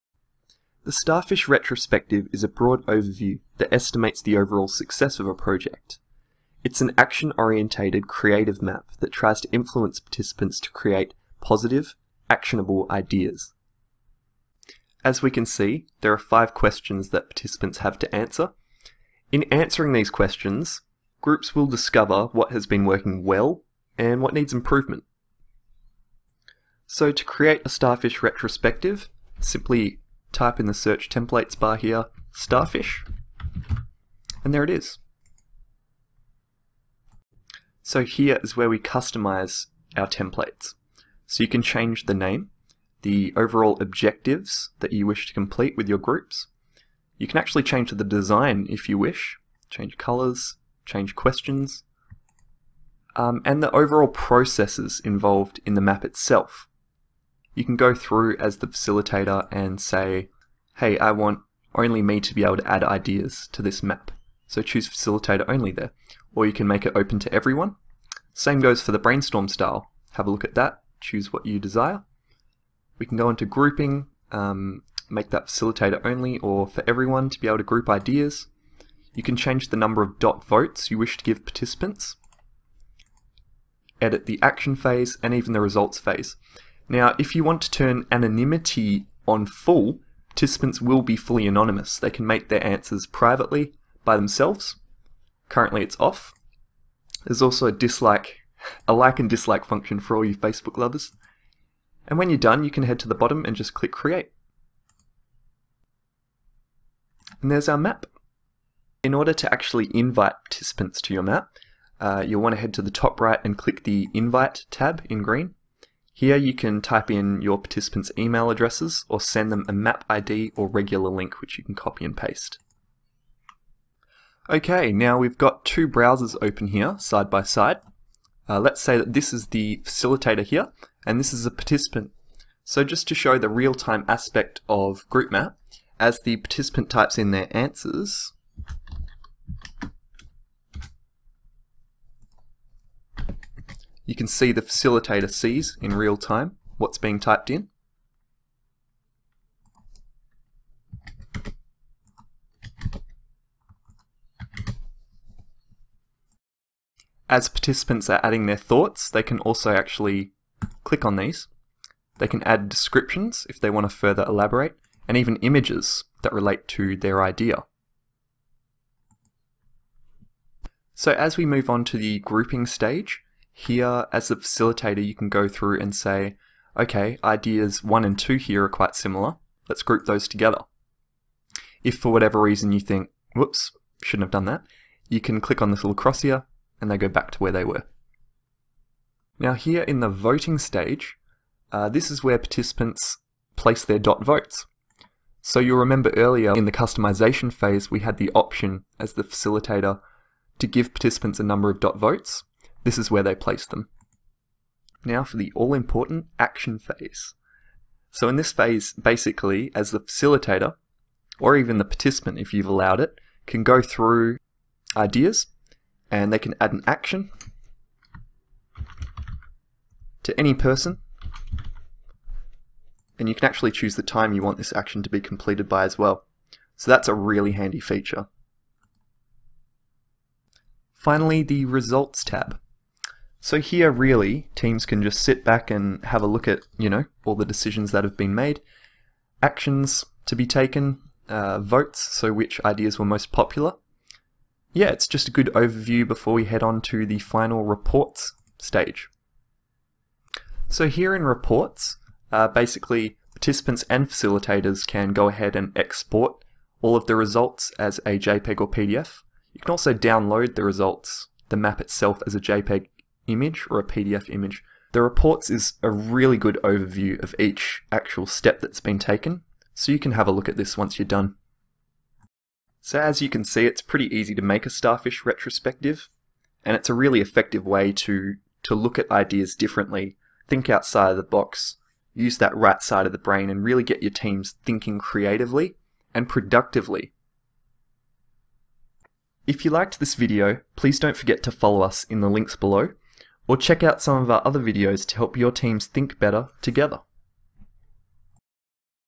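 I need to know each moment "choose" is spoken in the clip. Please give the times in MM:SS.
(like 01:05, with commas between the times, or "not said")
01:04, 01:11, 03:43.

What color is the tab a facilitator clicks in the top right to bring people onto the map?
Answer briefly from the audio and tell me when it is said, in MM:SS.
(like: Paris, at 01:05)
Green, at 01:55.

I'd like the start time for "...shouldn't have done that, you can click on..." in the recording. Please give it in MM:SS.
03:04.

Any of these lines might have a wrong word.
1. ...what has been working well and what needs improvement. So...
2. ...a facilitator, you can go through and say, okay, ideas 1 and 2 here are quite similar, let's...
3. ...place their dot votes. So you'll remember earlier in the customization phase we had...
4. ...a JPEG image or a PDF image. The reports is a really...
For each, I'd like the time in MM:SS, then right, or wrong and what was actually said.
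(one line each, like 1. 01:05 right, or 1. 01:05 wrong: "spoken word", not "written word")
1. 00:22 right
2. 02:54 right
3. 03:13 right
4. 04:22 right.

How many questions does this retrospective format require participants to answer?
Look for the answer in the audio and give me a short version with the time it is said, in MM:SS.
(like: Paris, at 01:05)
5, at 00:16.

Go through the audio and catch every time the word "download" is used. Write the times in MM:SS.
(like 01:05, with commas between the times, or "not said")
04:19.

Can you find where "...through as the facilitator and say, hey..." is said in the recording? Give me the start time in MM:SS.
00:57.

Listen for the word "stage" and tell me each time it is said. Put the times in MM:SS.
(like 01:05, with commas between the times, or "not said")
02:52, 03:10, 04:08.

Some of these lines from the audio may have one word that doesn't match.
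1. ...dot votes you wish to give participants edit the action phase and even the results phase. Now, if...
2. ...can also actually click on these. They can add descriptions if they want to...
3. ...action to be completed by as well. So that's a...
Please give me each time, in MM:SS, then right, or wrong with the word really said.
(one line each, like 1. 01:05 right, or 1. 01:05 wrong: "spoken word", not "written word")
1. 01:20 right
2. 02:39 right
3. 03:44 right.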